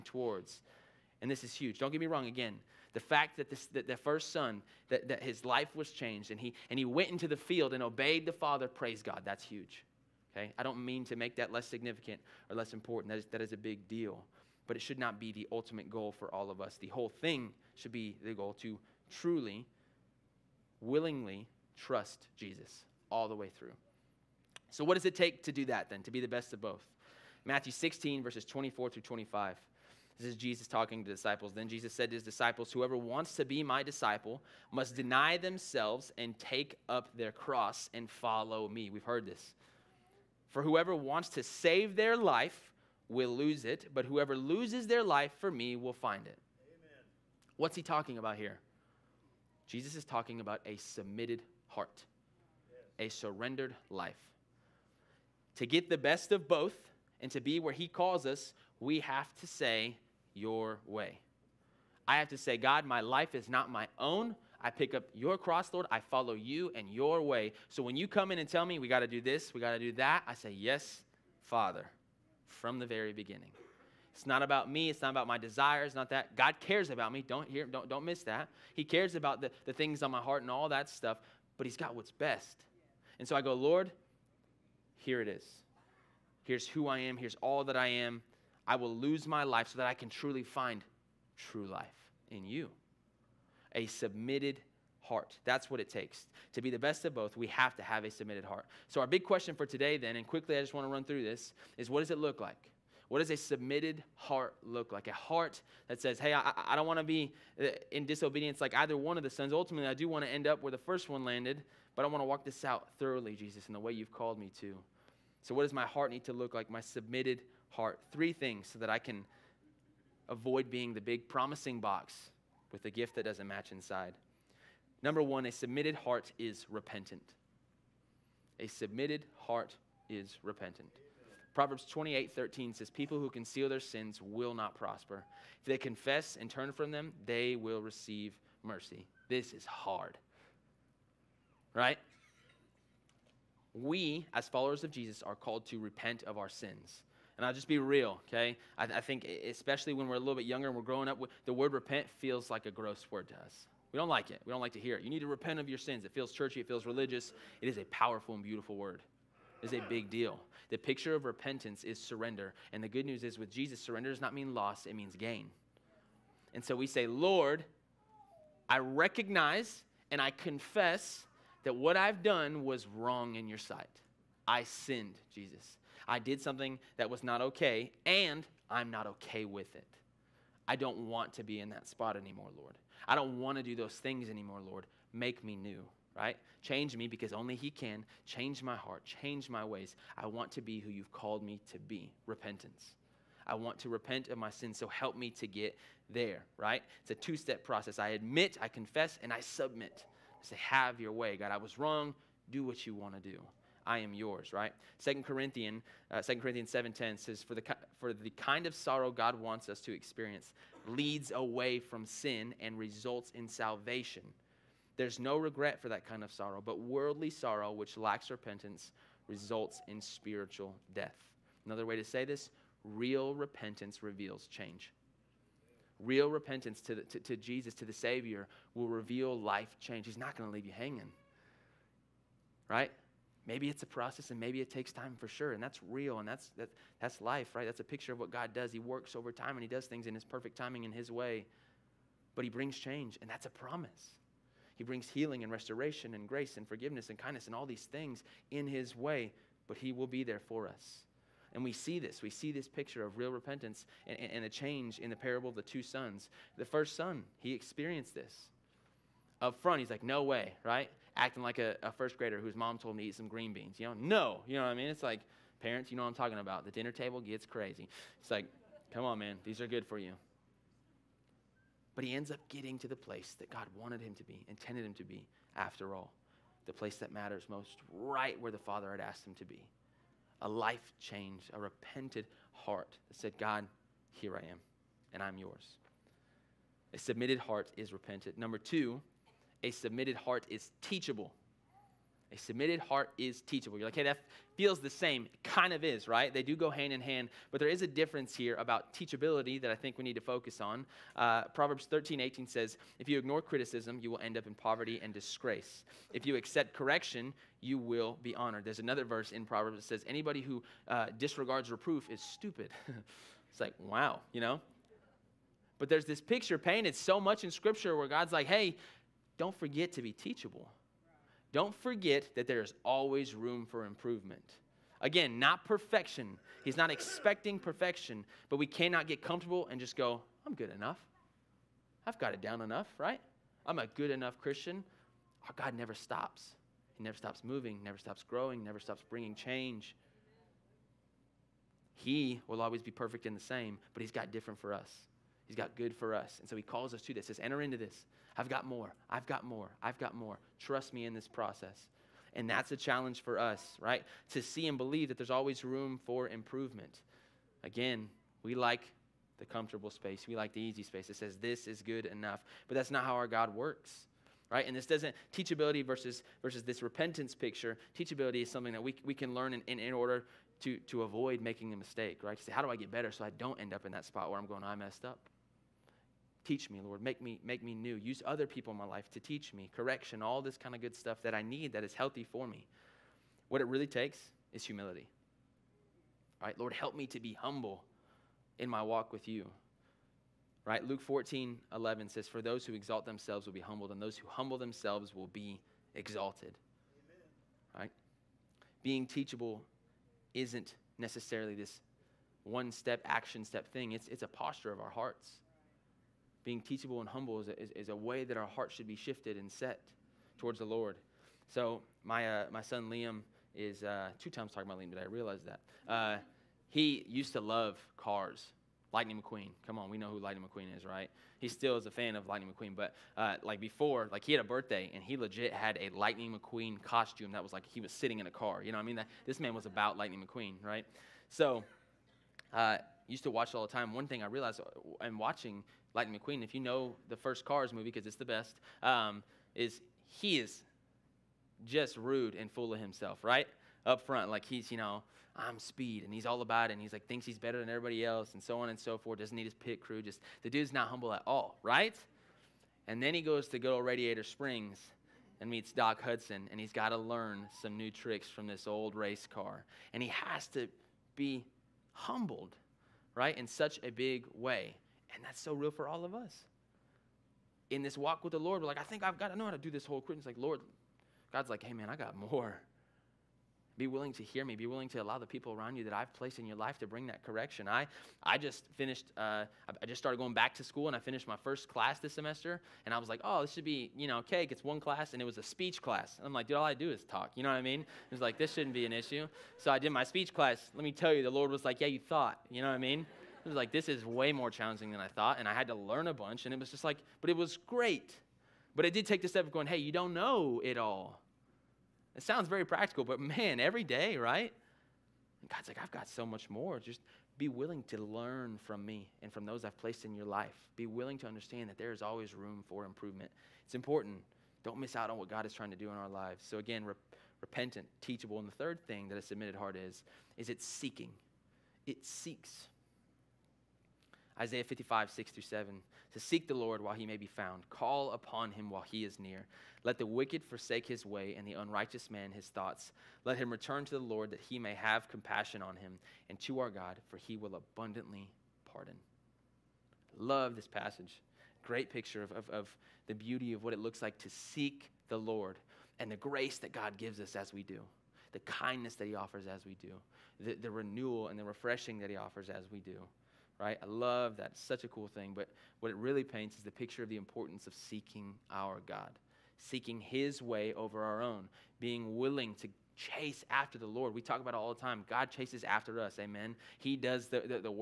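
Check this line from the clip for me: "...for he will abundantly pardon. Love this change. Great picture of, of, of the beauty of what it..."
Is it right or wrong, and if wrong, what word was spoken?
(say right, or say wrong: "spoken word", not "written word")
wrong: "passage", not "change".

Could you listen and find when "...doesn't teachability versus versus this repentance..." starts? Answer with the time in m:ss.
6:04.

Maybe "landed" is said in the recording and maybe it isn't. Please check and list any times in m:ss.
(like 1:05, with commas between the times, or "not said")
1:51.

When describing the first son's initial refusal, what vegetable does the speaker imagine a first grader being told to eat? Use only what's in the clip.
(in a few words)
green beans.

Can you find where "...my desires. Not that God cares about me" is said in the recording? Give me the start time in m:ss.
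1:15.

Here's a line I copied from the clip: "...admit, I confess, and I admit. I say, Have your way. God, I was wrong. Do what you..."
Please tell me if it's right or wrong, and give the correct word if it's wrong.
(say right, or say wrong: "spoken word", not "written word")
wrong: "submit", not "admit".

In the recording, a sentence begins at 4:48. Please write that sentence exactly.
Number two, a submitted heart is teachable.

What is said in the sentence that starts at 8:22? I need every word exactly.
It sounds very practical, but man, every day, right?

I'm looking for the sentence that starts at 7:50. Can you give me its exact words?
It's like, Lord, God's like, hey, man, I got more.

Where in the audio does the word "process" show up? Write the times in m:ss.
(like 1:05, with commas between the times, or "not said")
3:17, 3:53, 5:51.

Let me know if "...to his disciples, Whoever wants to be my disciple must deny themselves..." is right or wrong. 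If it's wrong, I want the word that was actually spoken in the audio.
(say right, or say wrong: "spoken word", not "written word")
right.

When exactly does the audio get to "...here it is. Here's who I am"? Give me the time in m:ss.
1:24.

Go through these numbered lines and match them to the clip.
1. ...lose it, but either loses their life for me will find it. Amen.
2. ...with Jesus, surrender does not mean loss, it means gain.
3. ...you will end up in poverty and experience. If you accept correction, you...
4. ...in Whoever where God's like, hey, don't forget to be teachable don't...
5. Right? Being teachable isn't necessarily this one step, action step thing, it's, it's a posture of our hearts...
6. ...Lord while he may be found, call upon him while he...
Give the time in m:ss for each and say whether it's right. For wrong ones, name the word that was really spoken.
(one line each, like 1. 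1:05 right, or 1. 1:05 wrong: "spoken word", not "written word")
1. 0:43 wrong: "whoever", not "either"
2. 2:43 right
3. 5:04 wrong: "disgrace", not "experience"
4. 5:17 wrong: "Scripture", not "Whoever"
5. 6:37 right
6. 8:46 right.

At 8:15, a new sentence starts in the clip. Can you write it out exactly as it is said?
And I had to learn a bunch.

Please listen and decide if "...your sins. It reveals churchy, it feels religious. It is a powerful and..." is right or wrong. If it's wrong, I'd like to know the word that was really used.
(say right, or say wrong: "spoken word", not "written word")
wrong: "feels", not "reveals".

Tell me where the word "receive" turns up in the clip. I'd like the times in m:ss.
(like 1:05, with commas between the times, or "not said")
2:17.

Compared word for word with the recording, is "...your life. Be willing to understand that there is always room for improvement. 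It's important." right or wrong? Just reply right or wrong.
right.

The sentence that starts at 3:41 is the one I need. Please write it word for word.
Another way to say this real repentance reveals change.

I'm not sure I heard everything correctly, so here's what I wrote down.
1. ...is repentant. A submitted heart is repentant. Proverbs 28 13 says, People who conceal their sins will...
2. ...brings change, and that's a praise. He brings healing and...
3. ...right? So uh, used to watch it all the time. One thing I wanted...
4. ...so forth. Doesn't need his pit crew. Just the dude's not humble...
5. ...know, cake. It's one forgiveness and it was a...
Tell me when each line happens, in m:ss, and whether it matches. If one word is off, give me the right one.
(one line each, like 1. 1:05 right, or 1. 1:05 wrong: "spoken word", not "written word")
1. 2:06 right
2. 4:02 wrong: "promise", not "praise"
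3. 7:10 wrong: "realized", not "wanted"
4. 7:28 right
5. 8:04 wrong: "class", not "forgiveness".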